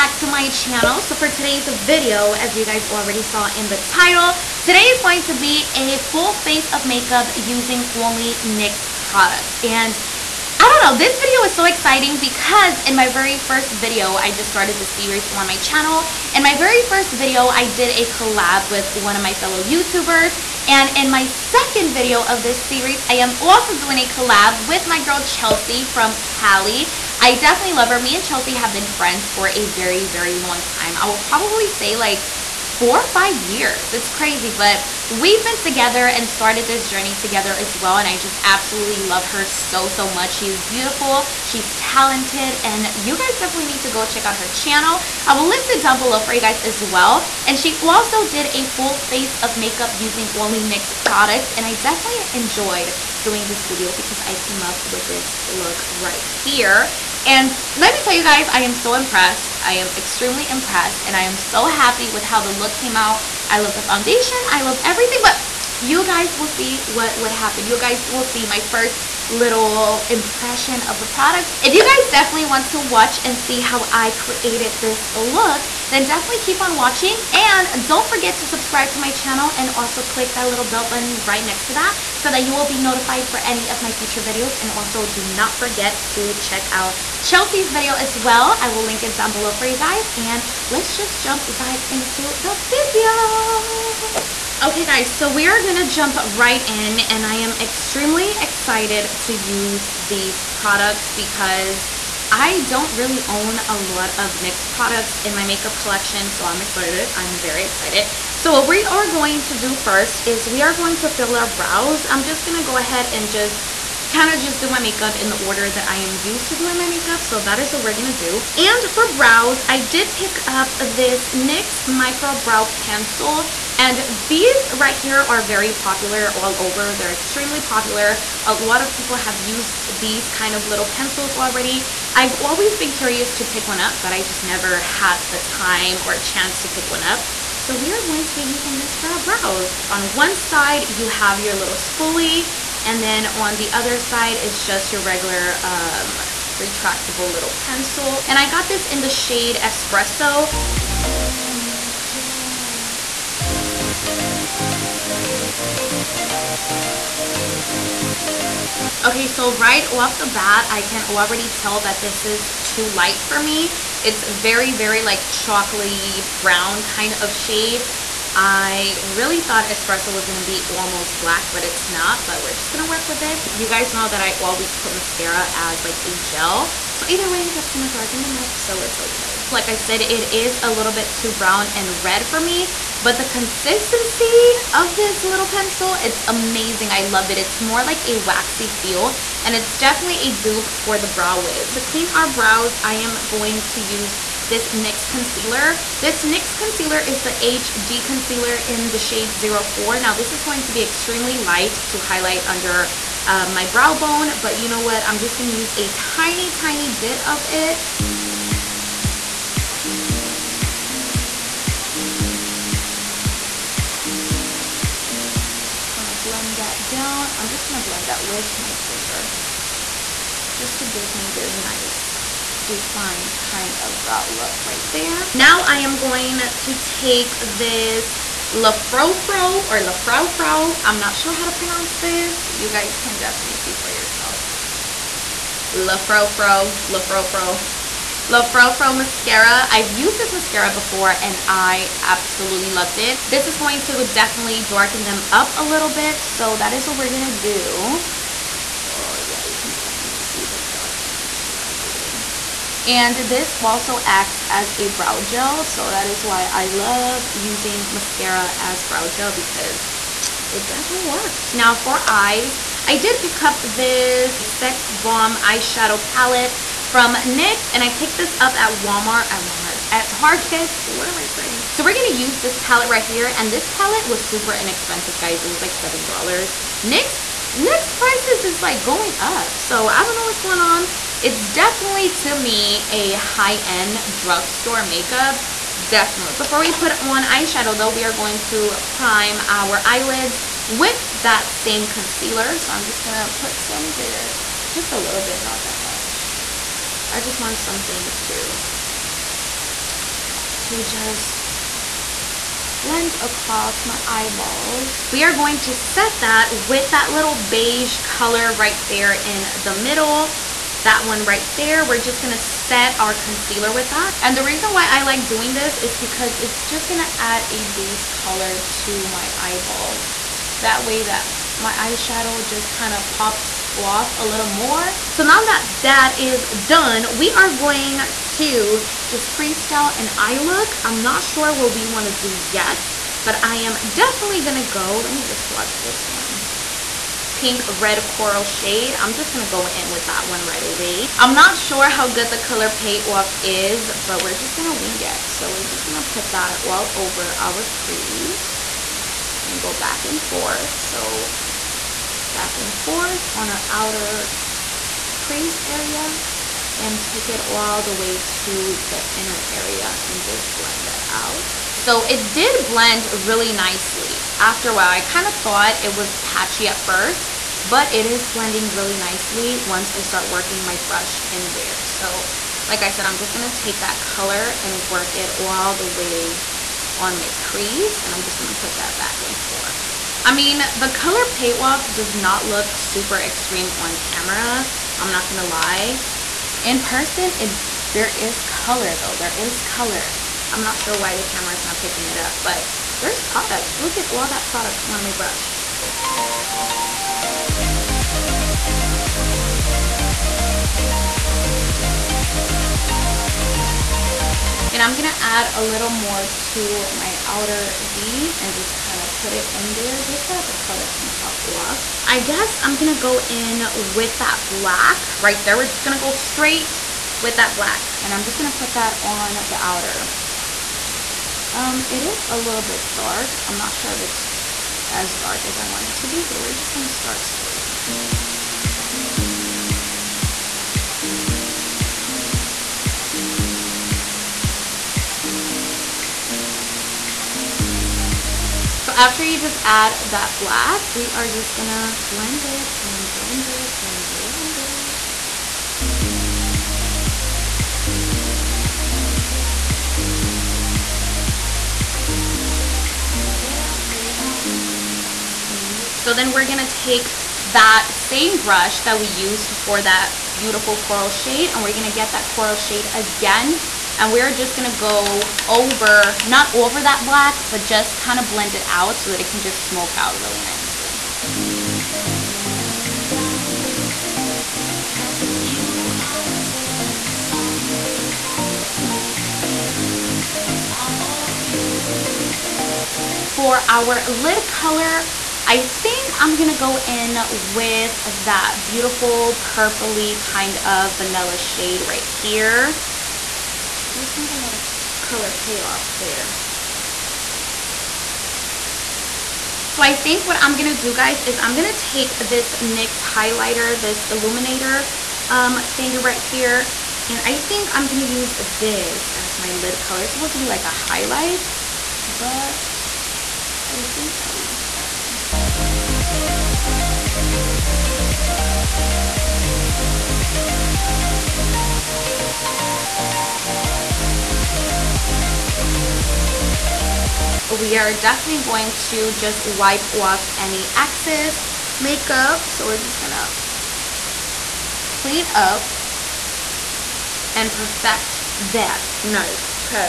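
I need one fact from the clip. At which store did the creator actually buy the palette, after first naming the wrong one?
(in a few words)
Target.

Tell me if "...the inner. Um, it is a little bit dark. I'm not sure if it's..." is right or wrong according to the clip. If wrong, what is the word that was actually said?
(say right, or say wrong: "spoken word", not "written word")
wrong: "outer", not "inner".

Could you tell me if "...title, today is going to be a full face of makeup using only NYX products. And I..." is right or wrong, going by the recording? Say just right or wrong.
right.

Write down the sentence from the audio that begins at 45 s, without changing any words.
I will list it down below for you guys as well.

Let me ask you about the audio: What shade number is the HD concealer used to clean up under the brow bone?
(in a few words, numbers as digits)
04.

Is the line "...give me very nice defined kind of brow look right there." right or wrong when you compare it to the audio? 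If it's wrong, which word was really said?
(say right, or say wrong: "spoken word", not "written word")
right.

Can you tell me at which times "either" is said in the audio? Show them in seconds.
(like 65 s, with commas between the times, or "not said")
177 s.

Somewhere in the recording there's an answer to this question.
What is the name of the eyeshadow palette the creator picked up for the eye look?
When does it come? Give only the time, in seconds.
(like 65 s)
264 s.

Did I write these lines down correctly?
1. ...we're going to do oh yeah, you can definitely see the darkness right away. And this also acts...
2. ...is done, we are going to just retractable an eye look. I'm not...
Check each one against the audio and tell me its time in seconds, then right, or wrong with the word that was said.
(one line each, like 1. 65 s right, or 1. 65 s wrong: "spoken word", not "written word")
1. 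246 s right
2. 326 s wrong: "freestyle", not "retractable".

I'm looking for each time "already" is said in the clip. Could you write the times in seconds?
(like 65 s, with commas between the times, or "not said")
2 s, 131 s, 161 s.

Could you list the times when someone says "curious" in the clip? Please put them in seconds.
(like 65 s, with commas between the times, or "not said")
132 s.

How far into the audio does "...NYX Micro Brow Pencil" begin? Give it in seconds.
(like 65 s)
121 s.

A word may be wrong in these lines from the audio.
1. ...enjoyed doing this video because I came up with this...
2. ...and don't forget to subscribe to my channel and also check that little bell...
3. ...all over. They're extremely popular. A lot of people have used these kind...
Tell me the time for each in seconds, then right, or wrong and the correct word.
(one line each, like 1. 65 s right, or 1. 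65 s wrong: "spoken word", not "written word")
1. 52 s right
2. 77 s wrong: "click", not "check"
3. 126 s right.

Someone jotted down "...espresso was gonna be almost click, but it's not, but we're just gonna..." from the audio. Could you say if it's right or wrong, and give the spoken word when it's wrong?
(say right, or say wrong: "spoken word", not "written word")
wrong: "black", not "click".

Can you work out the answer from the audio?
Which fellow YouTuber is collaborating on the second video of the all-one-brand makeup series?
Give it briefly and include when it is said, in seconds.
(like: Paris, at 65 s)
Chelsea from Cali, at 25 s.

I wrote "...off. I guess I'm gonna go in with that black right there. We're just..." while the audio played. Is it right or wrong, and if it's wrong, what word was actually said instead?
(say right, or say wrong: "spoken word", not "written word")
right.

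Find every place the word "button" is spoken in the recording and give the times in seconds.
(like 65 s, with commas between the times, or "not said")
80 s.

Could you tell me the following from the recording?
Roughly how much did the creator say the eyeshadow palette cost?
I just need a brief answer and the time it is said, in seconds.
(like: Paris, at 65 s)
$7, at 275 s.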